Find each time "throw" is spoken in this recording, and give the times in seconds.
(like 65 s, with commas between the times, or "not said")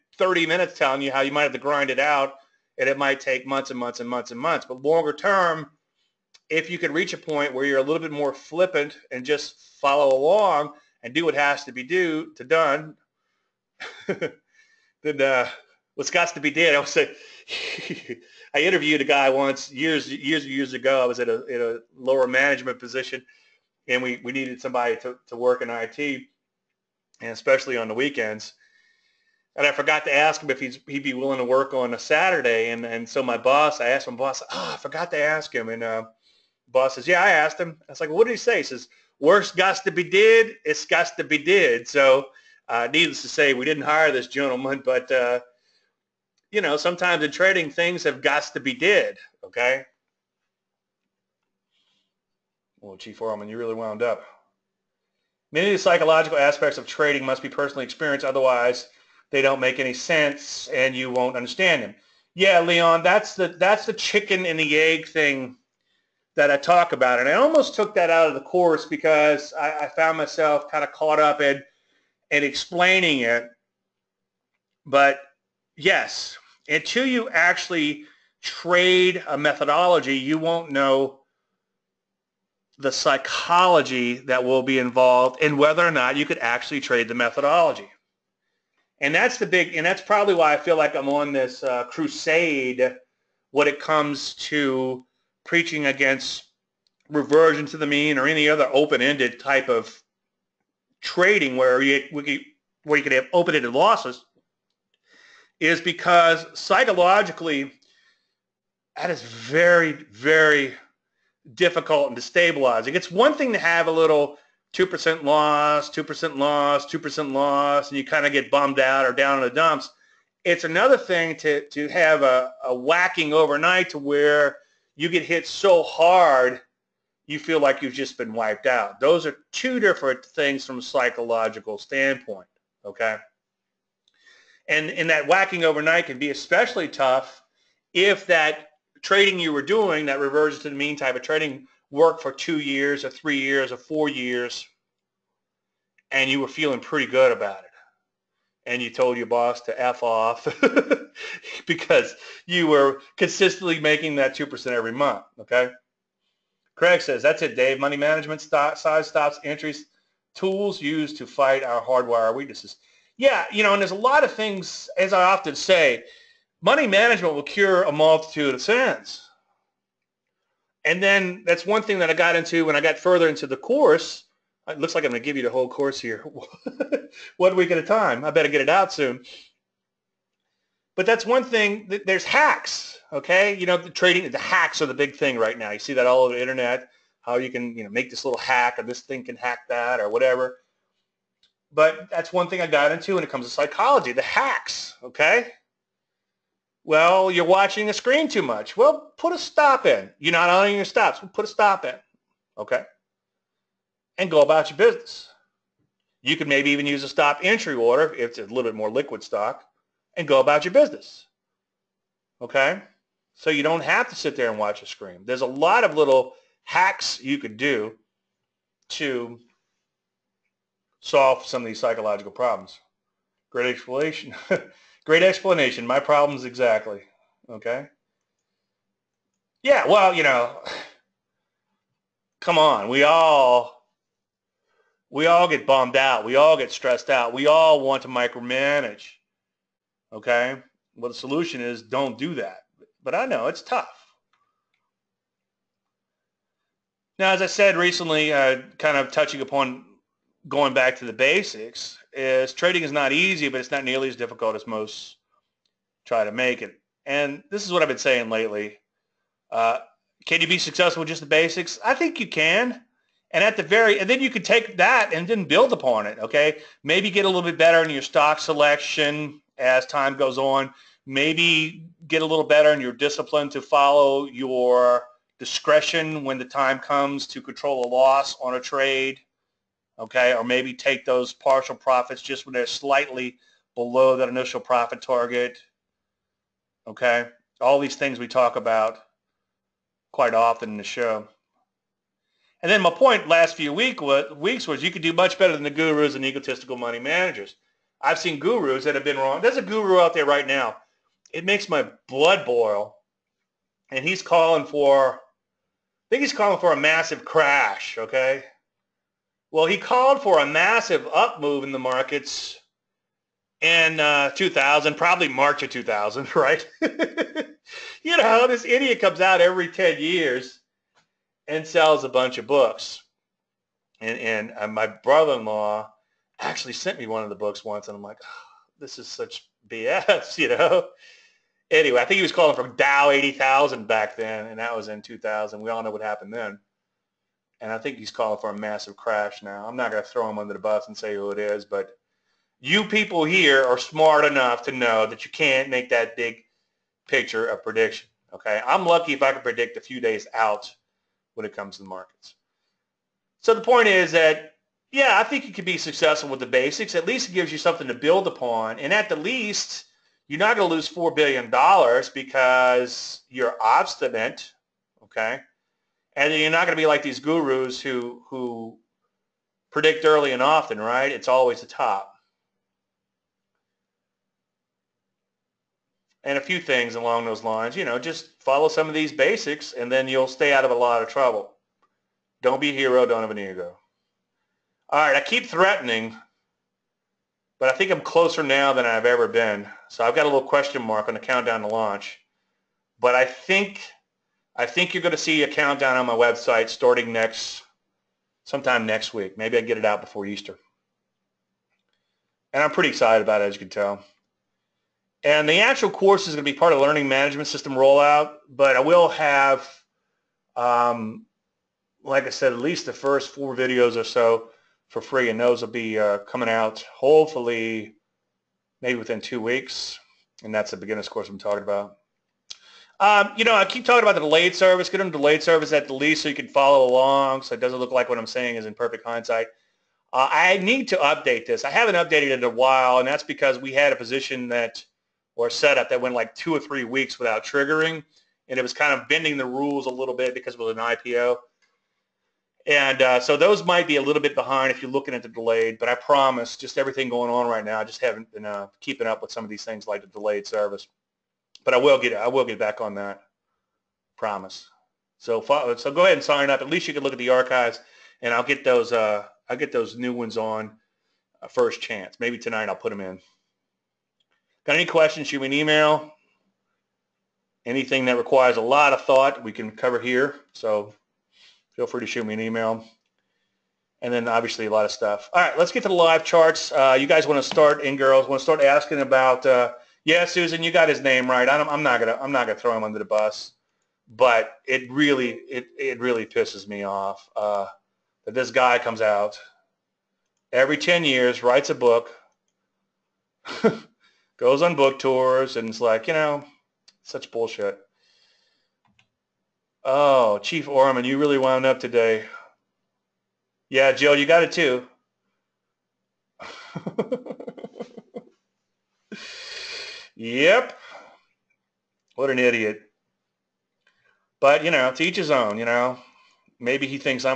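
340 s, 482 s.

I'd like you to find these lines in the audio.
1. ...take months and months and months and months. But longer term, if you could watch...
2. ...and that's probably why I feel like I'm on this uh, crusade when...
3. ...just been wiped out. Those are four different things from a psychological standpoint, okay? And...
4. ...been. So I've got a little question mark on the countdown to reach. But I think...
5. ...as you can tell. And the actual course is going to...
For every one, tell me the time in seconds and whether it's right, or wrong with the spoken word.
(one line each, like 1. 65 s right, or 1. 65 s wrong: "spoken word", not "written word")
1. 3 s wrong: "reach", not "watch"
2. 89 s right
3. 127 s wrong: "two", not "four"
4. 389 s wrong: "launch", not "reach"
5. 403 s right.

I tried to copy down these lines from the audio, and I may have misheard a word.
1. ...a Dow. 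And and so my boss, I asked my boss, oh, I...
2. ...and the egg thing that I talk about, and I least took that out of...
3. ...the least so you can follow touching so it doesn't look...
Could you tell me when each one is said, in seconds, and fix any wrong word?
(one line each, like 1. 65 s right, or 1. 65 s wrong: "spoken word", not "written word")
1. 31 s wrong: "Saturday", not "Dow"
2. 64 s wrong: "almost", not "least"
3. 425 s wrong: "along", not "touching".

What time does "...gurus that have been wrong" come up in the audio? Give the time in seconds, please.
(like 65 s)
298 s.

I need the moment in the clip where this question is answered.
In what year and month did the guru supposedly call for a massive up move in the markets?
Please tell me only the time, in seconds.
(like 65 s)
315 s.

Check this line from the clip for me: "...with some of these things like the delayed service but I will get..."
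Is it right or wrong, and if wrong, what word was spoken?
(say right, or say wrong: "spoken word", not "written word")
right.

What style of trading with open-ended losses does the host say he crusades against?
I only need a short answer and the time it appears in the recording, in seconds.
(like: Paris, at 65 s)
reversion to the mean, at 97 s.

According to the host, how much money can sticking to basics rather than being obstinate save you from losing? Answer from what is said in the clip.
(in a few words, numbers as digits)
four billion dollars.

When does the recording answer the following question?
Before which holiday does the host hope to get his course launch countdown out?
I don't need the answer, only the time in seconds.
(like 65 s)
400 s.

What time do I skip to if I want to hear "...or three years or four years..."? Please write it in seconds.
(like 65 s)
143 s.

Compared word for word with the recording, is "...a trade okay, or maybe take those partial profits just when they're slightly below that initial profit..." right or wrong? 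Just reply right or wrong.
right.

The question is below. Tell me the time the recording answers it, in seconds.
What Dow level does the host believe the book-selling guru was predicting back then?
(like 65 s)
332 s.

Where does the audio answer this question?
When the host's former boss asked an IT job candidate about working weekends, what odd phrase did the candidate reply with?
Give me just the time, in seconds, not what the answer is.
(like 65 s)
39 s.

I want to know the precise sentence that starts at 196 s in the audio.
Well, you're watching the screen too much.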